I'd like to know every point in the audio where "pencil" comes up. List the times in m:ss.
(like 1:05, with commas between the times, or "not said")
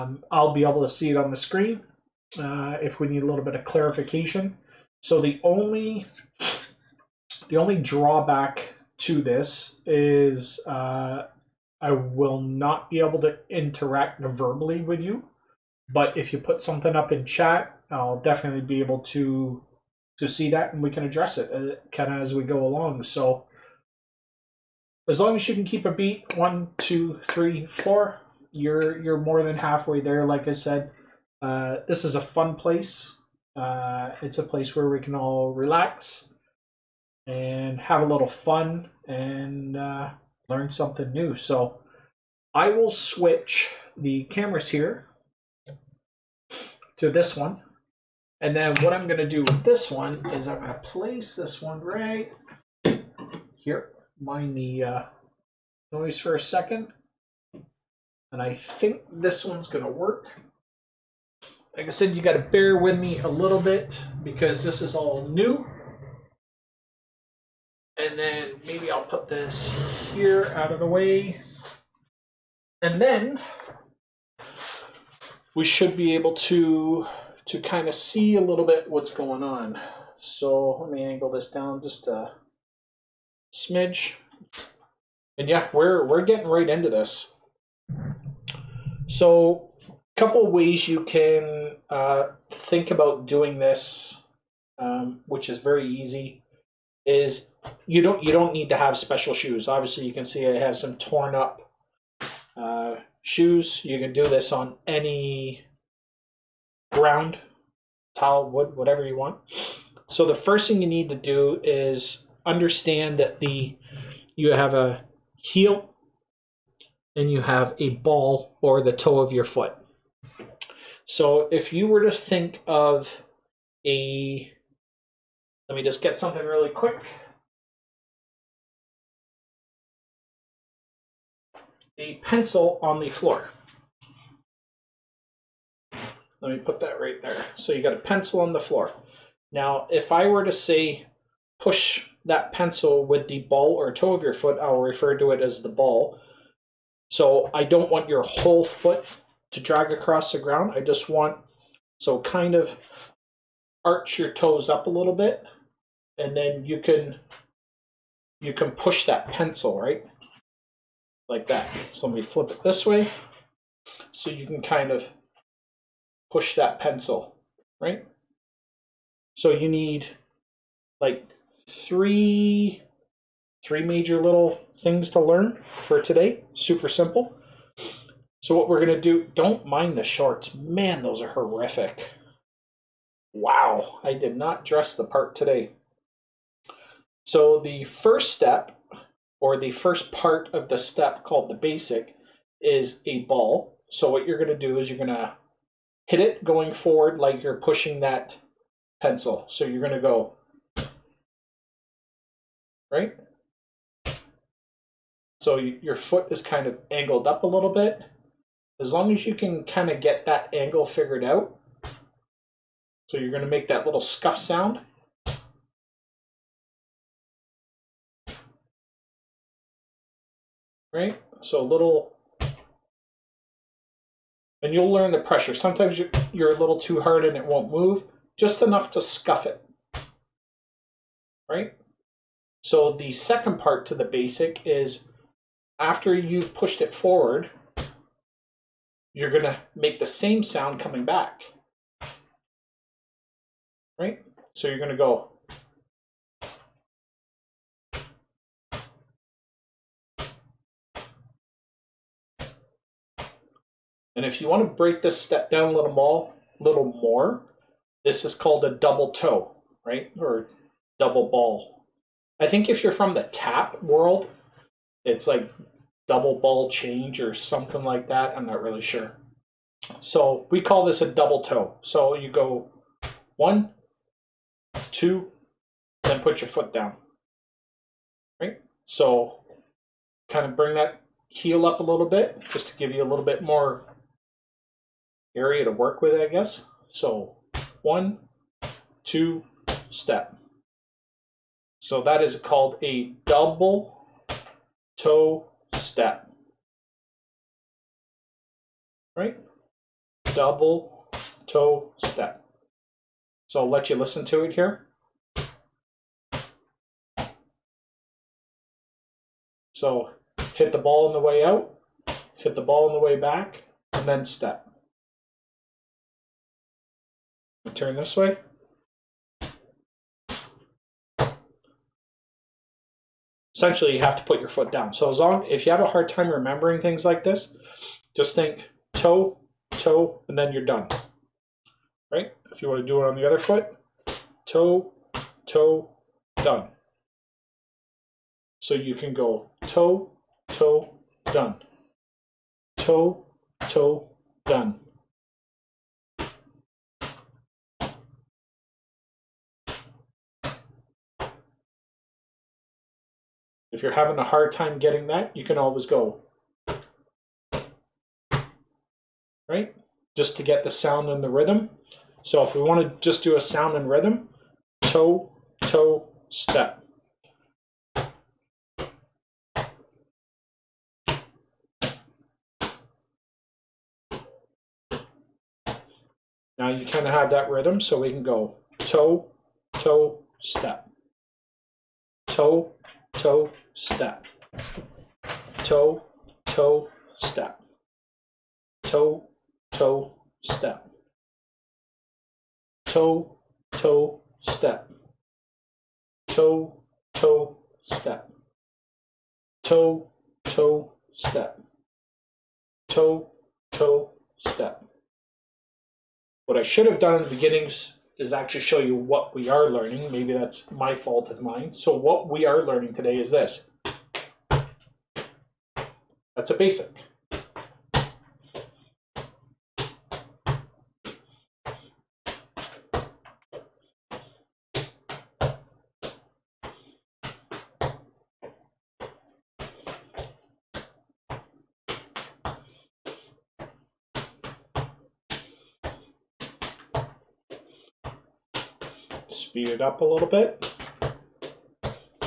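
2:12, 2:17, 2:22, 2:39, 2:46, 3:19.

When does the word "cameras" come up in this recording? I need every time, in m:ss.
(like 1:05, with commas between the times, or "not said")
0:44.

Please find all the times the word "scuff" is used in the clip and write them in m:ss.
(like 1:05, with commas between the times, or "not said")
3:33, 3:48.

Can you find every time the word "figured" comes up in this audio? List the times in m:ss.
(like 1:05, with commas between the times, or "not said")
3:30.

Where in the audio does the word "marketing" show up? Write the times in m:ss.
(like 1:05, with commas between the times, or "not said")
not said.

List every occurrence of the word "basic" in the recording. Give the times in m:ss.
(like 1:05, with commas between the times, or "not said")
3:11, 3:54, 6:56.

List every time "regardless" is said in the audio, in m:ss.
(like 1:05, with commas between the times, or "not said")
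not said.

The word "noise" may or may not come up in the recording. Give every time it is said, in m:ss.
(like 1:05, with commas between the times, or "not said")
0:55.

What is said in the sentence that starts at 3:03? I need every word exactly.
Wow, I did not dress the part today.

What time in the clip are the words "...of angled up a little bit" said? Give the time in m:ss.
3:26.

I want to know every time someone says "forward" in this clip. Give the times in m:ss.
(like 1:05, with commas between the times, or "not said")
3:16, 3:56.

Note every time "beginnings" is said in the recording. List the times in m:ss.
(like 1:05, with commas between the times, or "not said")
6:47.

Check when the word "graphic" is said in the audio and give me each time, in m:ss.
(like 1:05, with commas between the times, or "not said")
not said.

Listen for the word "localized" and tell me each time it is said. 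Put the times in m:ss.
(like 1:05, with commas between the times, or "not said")
not said.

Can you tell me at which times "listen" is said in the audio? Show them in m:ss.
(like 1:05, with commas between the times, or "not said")
5:03.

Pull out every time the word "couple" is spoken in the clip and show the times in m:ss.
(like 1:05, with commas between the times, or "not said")
1:30.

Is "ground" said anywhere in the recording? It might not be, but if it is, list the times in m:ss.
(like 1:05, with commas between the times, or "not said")
1:46, 2:30.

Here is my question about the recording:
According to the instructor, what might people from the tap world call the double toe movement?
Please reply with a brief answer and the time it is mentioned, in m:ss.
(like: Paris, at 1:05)
double ball change, at 4:26.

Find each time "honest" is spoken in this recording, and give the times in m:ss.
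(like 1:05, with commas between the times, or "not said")
not said.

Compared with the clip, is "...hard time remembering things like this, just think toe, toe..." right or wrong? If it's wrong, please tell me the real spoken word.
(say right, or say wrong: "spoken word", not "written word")
right.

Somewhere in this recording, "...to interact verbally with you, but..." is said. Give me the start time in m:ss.
0:13.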